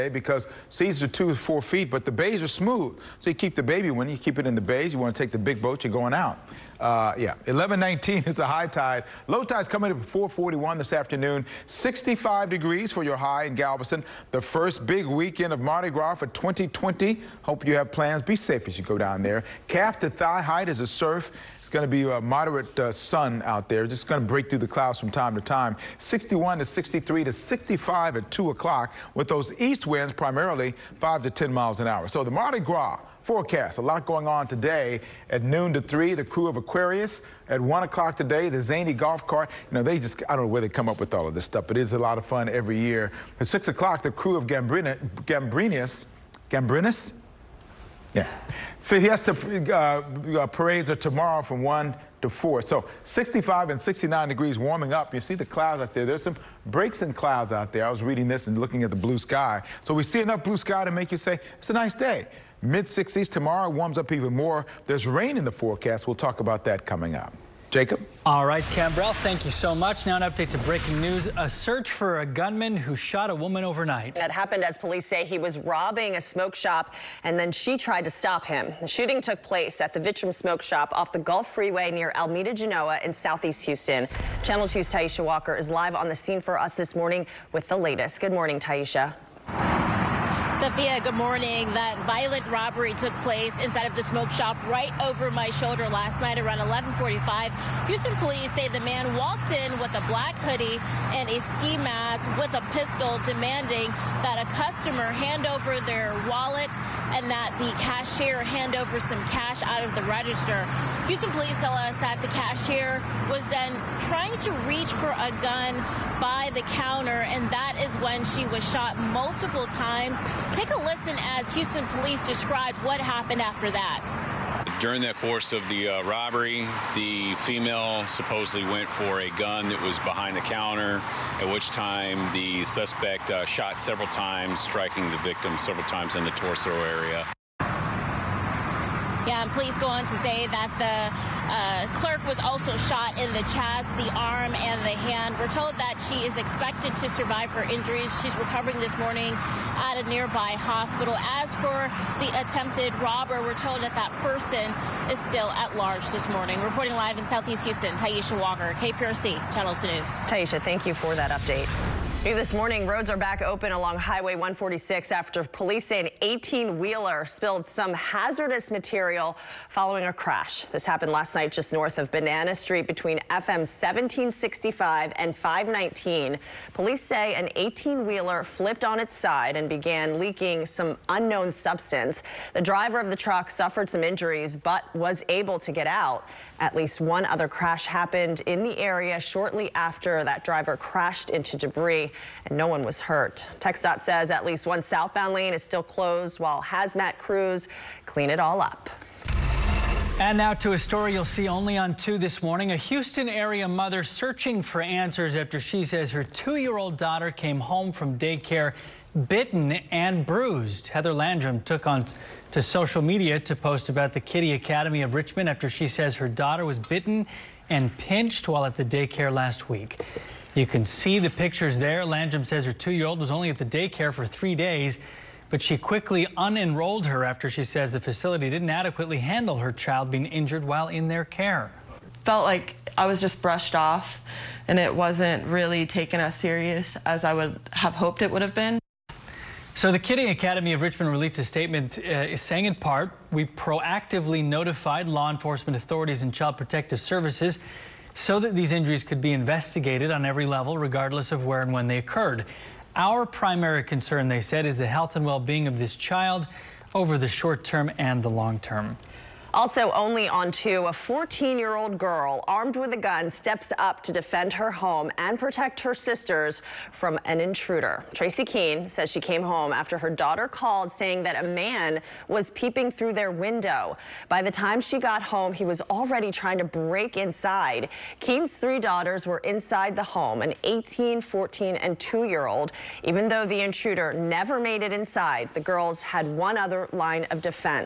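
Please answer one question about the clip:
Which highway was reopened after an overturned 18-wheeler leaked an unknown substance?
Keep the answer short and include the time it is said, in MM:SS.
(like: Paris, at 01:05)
Highway 146, at 02:43.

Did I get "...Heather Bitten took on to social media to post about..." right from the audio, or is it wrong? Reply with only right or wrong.
wrong.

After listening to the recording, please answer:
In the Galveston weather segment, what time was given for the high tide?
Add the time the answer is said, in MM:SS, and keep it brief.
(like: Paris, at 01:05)
11:19, at 00:07.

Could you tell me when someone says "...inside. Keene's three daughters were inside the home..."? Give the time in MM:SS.
04:37.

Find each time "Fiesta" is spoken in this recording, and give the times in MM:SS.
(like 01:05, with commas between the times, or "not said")
00:48.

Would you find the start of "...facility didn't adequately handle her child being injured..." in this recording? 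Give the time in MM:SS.
03:47.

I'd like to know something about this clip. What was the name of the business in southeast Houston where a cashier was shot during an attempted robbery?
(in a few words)
Vitrum Smoke Shop.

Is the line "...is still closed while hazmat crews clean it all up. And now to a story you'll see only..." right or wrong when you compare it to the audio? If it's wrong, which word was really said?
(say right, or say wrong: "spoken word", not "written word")
right.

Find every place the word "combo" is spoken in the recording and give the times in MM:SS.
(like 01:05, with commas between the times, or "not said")
not said.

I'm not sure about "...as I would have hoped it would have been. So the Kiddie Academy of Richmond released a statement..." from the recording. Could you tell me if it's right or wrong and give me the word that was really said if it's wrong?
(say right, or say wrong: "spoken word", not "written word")
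right.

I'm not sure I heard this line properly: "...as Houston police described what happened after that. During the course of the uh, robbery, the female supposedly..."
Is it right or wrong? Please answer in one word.
right.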